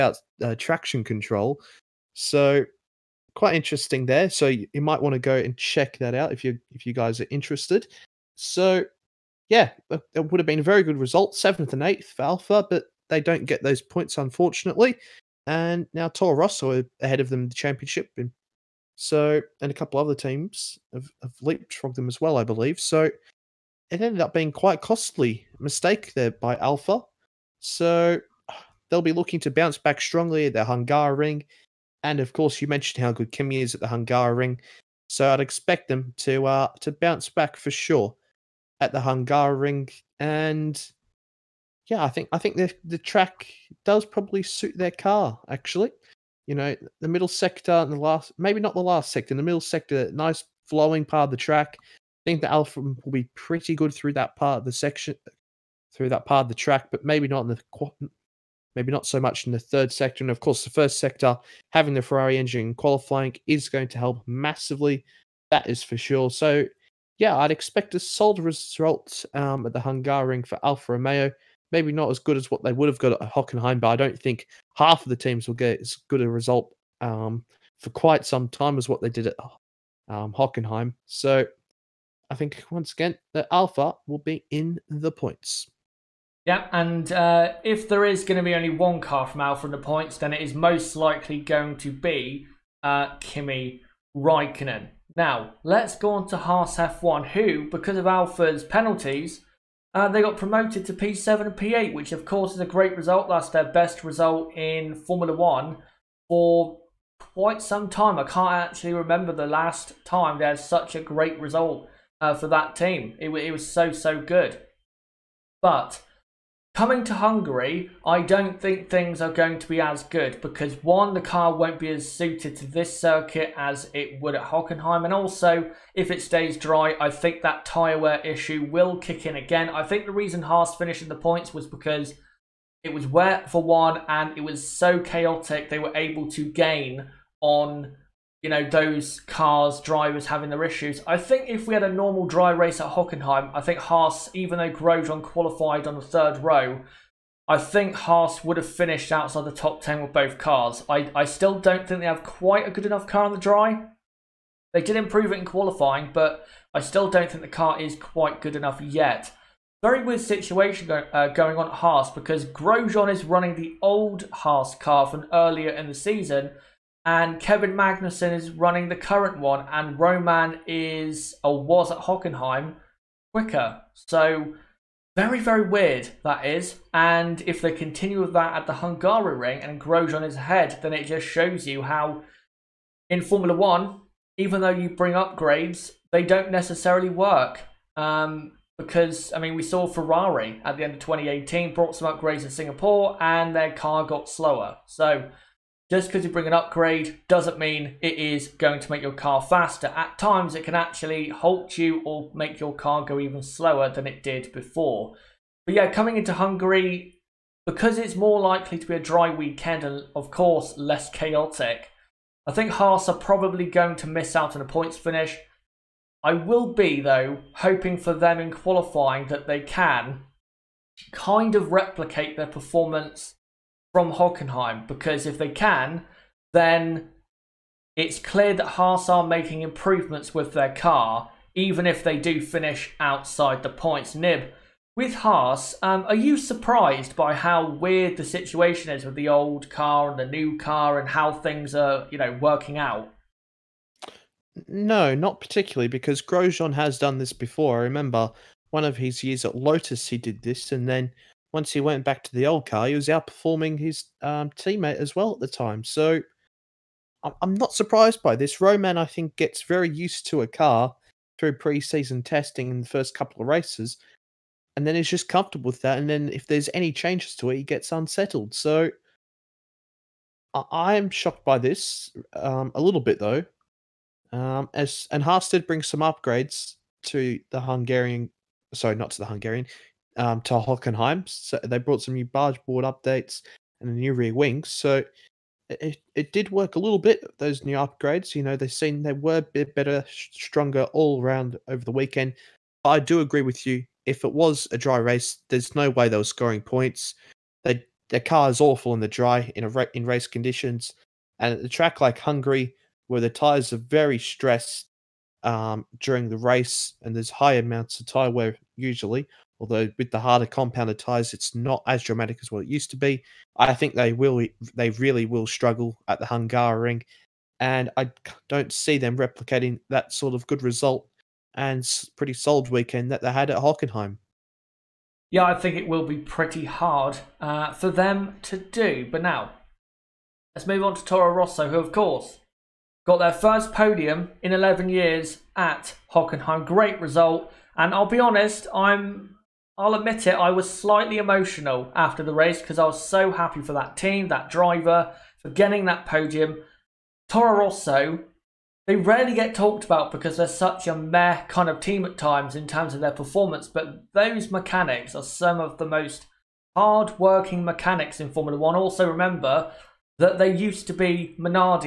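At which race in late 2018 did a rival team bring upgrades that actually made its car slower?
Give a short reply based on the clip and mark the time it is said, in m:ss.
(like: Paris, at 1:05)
Singapore, at 3:12.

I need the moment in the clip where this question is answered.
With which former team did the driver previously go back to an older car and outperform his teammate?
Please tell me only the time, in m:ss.
4:09.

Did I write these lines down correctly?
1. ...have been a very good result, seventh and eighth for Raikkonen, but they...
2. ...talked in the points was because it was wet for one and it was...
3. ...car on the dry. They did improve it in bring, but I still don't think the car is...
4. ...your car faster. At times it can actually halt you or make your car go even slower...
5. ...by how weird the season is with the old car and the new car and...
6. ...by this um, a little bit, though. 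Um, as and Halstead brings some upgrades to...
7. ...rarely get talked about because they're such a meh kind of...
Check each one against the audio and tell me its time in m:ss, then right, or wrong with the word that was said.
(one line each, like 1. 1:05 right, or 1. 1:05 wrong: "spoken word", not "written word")
1. 0:10 wrong: "Alfa", not "Raikkonen"
2. 2:10 wrong: "finished", not "talked"
3. 2:33 wrong: "qualifying", not "bring"
4. 3:19 right
5. 3:57 wrong: "situation", not "season"
6. 4:31 right
7. 5:48 right.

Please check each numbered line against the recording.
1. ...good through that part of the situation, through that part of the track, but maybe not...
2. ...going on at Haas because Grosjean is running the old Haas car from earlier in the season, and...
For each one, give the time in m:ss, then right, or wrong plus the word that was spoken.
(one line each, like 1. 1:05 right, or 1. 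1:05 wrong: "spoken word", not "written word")
1. 0:53 wrong: "section", not "situation"
2. 2:41 right.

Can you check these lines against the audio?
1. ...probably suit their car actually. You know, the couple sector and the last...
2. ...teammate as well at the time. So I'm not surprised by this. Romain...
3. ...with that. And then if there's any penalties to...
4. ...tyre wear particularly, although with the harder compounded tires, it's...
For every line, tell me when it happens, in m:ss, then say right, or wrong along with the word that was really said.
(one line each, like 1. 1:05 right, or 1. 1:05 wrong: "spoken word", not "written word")
1. 0:44 wrong: "middle", not "couple"
2. 4:14 right
3. 4:25 wrong: "changes", not "penalties"
4. 5:08 wrong: "usually", not "particularly".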